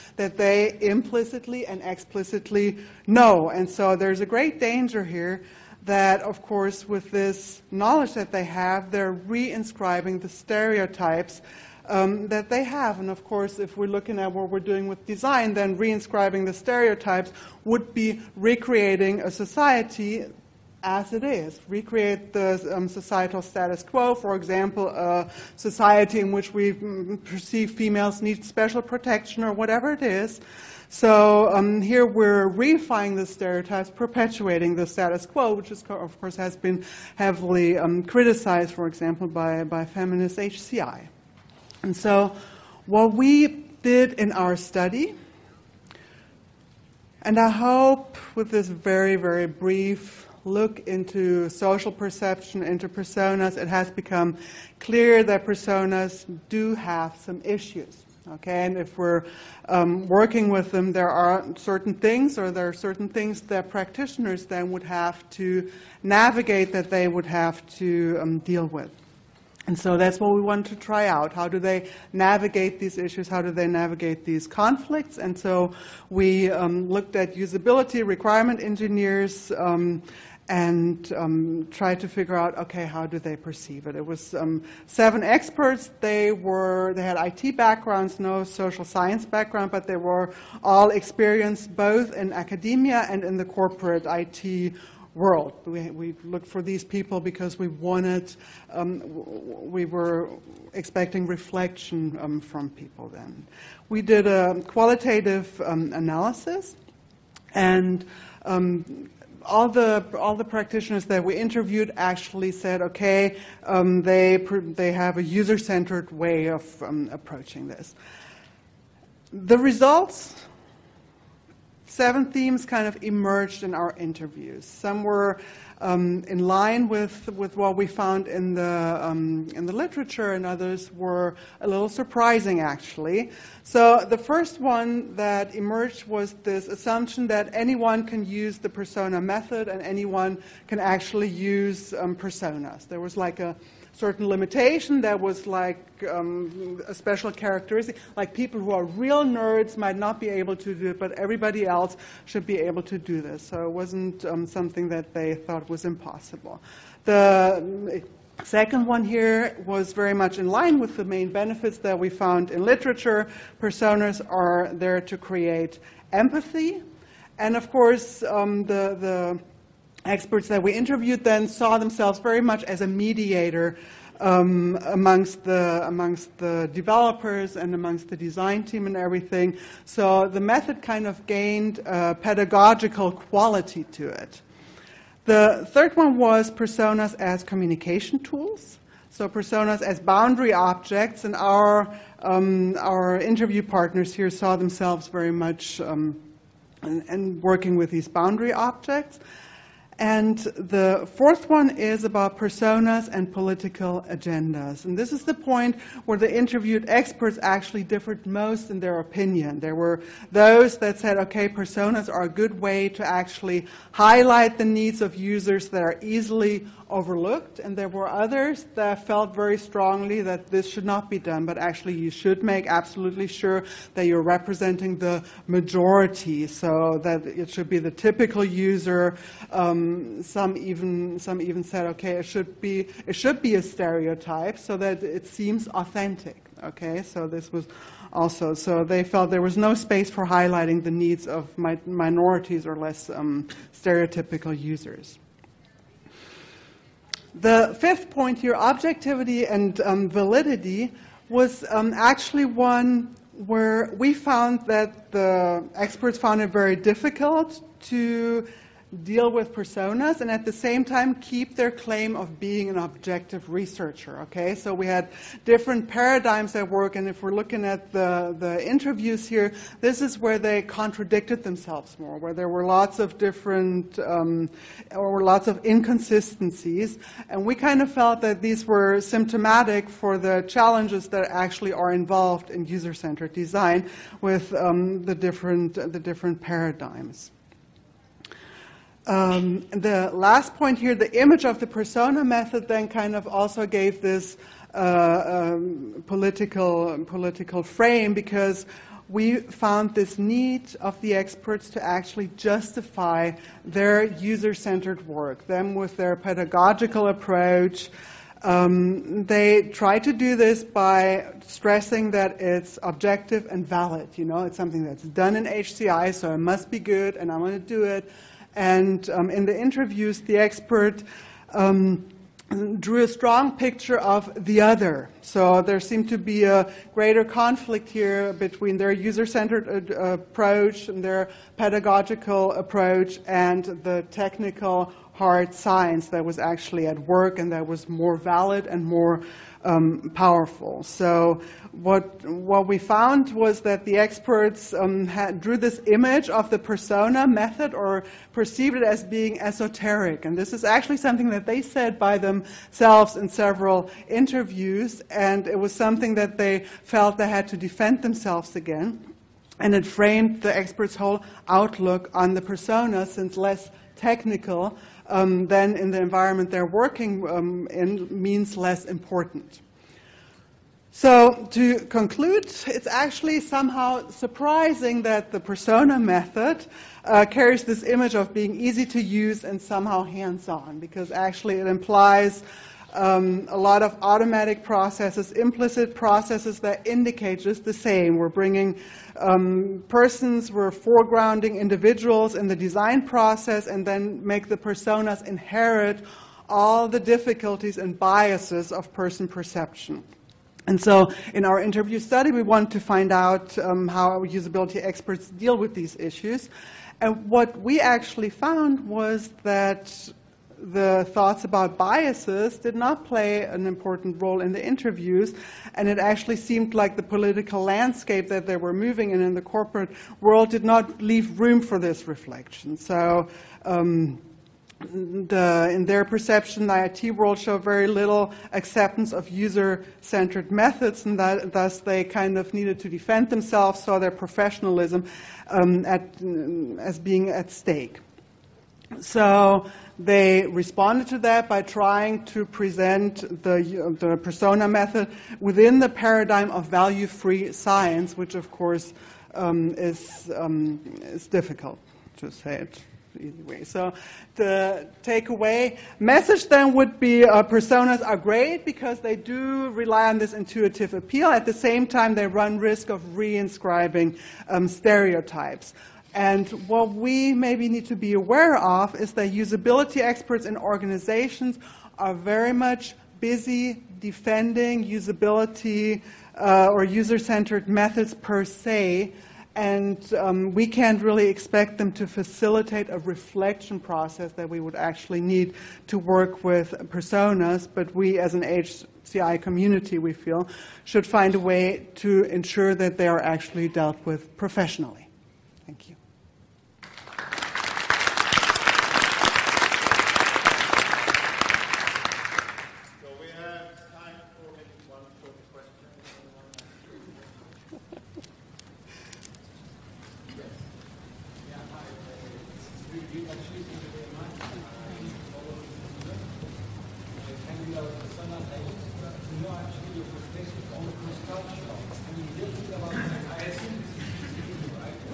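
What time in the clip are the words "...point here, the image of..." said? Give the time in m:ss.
4:50.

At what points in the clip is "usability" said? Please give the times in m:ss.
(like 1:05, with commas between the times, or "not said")
1:17, 6:44, 7:49, 7:54.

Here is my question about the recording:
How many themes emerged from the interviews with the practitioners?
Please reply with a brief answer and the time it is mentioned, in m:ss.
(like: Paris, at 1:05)
7, at 2:01.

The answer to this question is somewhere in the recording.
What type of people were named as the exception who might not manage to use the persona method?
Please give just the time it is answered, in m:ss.
2:28.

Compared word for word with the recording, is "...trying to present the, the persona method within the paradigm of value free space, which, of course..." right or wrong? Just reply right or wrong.
wrong.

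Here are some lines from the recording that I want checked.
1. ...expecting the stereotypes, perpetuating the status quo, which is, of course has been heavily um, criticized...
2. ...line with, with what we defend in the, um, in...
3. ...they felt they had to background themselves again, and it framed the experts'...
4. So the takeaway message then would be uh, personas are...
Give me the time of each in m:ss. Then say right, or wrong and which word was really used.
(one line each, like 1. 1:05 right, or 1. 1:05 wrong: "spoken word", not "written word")
1. 0:32 wrong: "reifying", not "expecting"
2. 2:06 wrong: "found", not "defend"
3. 5:56 wrong: "defend", not "background"
4. 7:33 right.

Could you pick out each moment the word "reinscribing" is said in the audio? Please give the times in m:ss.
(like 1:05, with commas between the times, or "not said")
0:09, 0:15, 7:43.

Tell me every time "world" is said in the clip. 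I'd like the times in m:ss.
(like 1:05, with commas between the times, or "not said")
1:35, 7:00, 7:07.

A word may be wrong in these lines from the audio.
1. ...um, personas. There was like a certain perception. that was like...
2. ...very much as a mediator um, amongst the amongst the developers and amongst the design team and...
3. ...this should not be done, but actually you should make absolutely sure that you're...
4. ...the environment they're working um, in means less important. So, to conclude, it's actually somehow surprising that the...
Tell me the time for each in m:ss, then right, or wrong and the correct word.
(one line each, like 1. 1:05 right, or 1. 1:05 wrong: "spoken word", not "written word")
1. 2:21 wrong: "limitation", not "perception"
2. 2:52 right
3. 3:40 right
4. 6:05 right.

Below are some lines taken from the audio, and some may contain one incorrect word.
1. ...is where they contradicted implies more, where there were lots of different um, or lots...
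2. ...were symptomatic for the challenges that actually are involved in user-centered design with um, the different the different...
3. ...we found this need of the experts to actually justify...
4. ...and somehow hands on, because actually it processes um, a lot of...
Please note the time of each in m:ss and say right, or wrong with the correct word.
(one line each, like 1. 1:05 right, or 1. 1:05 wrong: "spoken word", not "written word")
1. 4:30 wrong: "themselves", not "implies"
2. 4:38 right
3. 4:59 right
4. 6:19 wrong: "implies", not "processes".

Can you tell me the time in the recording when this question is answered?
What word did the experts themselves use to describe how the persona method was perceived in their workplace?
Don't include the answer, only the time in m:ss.
5:49.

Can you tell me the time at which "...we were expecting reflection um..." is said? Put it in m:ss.
1:39.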